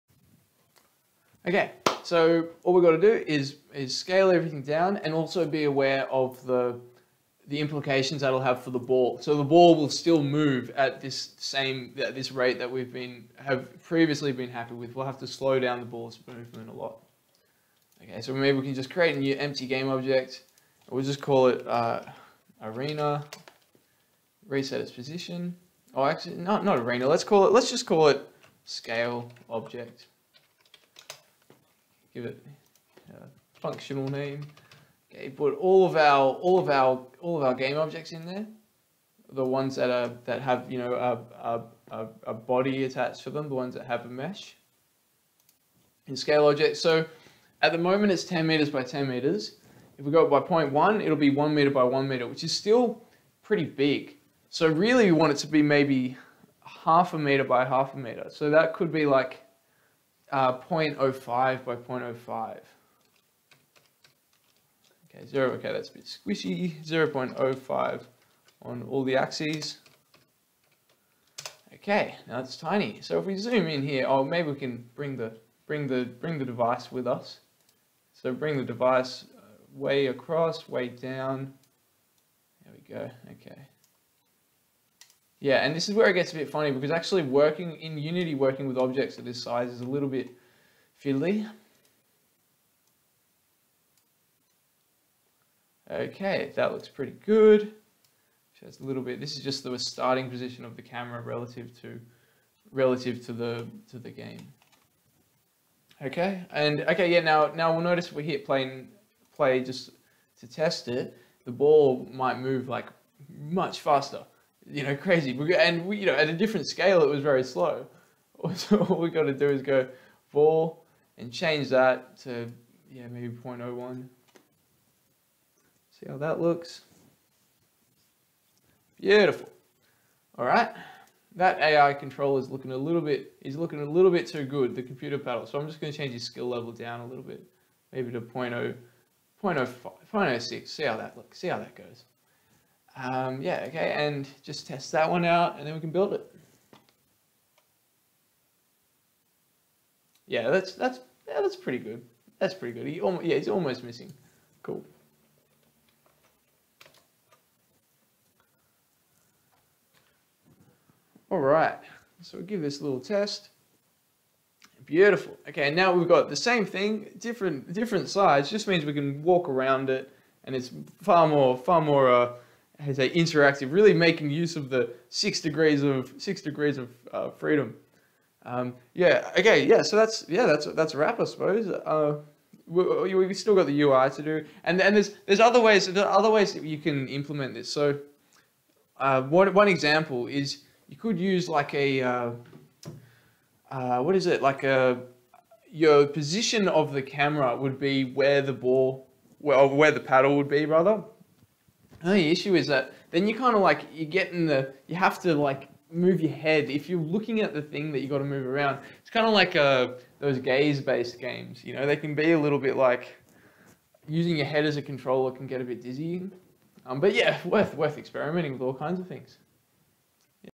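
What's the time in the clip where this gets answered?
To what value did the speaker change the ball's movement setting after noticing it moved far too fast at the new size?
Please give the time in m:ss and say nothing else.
2:03.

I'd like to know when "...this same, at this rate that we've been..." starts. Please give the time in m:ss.
0:11.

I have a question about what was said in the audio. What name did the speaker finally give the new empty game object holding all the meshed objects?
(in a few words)
scale object.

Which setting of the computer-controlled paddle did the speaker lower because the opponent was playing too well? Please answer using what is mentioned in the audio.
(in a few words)
skill level.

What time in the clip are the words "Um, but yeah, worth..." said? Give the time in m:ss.
3:36.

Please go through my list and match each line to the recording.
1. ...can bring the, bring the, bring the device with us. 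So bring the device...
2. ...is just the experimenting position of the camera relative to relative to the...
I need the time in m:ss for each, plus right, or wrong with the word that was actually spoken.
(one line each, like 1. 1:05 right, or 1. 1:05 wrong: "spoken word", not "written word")
1. 1:14 right
2. 1:39 wrong: "starting", not "experimenting".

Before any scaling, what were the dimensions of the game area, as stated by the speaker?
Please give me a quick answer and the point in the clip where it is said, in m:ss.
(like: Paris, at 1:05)
10 meters by 10 meters, at 0:48.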